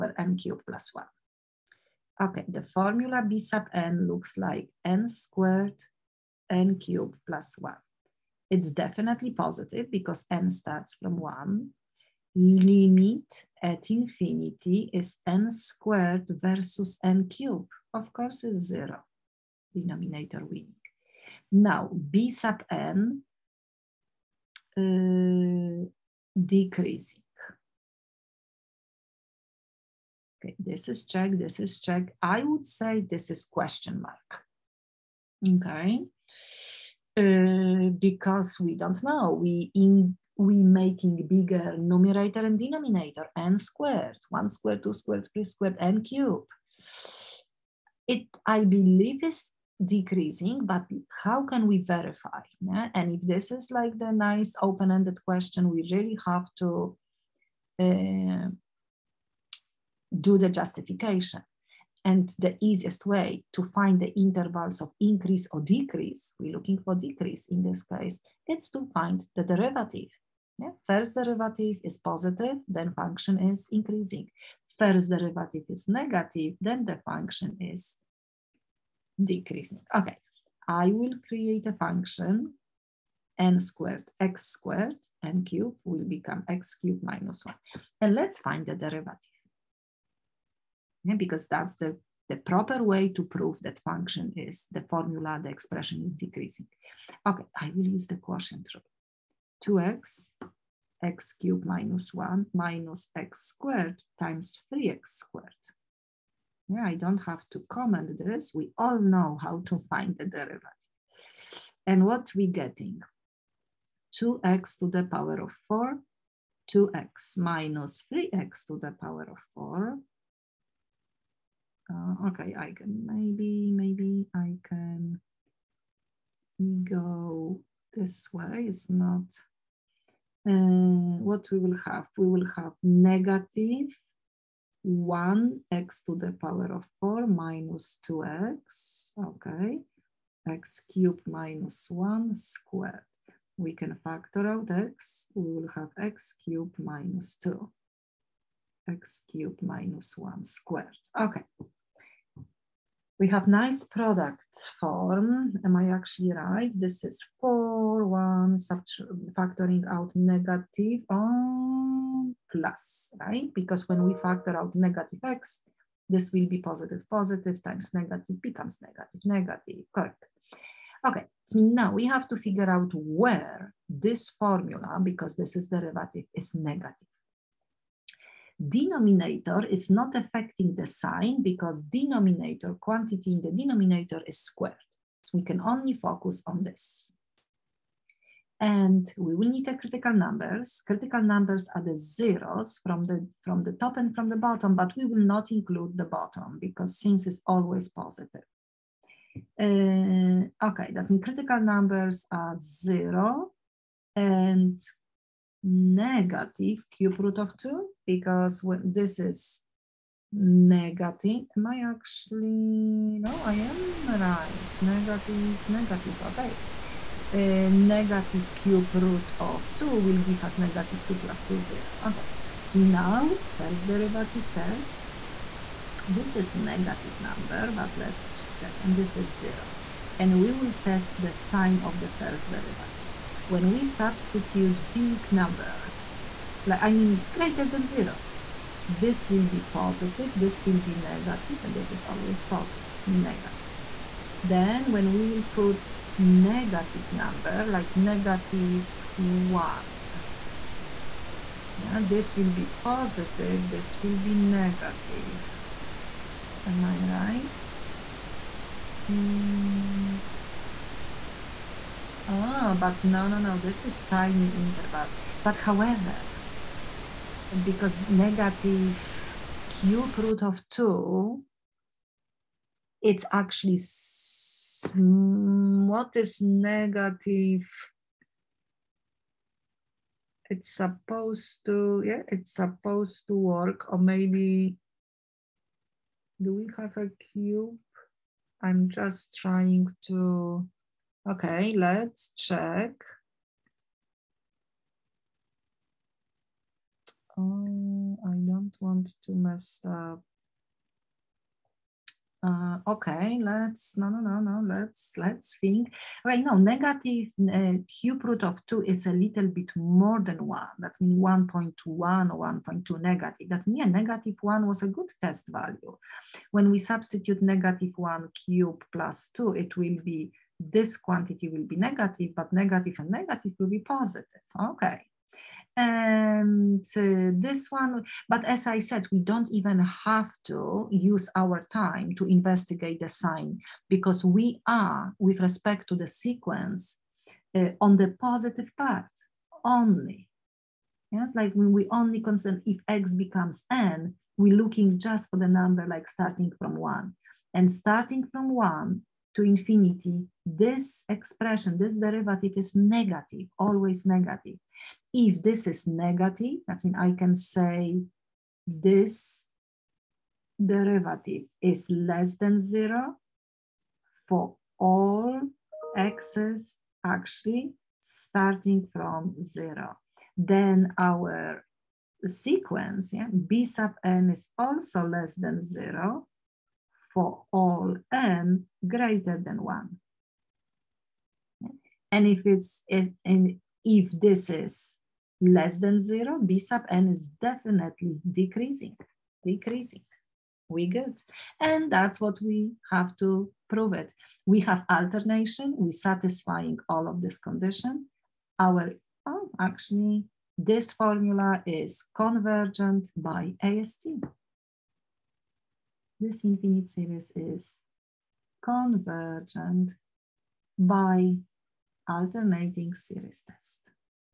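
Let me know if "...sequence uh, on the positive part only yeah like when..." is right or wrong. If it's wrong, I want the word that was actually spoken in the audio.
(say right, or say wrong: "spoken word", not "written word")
right.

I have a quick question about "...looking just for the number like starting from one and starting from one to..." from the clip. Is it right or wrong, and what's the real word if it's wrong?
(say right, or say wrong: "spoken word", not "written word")
right.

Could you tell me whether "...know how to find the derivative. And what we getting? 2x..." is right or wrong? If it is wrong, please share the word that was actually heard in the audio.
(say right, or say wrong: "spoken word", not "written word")
right.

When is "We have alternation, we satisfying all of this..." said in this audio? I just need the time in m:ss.
6:34.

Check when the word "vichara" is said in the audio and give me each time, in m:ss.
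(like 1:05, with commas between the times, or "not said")
not said.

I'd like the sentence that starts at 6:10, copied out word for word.
Then our sequence, yeah, b sub n is also less than zero for all n greater than one.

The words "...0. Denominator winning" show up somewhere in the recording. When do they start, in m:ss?
0:18.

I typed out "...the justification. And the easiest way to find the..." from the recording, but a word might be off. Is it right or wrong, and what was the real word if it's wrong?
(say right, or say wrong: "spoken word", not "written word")
right.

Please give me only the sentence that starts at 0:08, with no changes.
It's definitely positive because n starts from 1.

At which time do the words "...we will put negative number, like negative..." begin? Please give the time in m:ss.
4:05.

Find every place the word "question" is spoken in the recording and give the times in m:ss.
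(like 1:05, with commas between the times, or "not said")
0:33, 0:55.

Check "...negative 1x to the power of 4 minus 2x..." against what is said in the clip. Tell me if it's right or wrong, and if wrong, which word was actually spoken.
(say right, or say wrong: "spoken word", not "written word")
right.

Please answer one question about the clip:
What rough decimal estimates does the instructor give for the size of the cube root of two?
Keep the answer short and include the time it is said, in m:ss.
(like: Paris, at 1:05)
1.1 or 1.2, at 5:11.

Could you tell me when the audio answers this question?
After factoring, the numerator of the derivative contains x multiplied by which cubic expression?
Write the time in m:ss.
2:26.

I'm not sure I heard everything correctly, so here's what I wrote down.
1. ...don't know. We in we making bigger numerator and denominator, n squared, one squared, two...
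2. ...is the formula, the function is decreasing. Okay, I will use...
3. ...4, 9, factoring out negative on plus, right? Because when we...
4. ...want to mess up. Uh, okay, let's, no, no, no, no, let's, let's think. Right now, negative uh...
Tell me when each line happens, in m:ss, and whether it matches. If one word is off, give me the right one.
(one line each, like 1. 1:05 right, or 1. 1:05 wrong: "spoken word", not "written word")
1. 0:38 right
2. 1:34 wrong: "expression", not "function"
3. 2:37 wrong: "1", not "9"
4. 4:58 right.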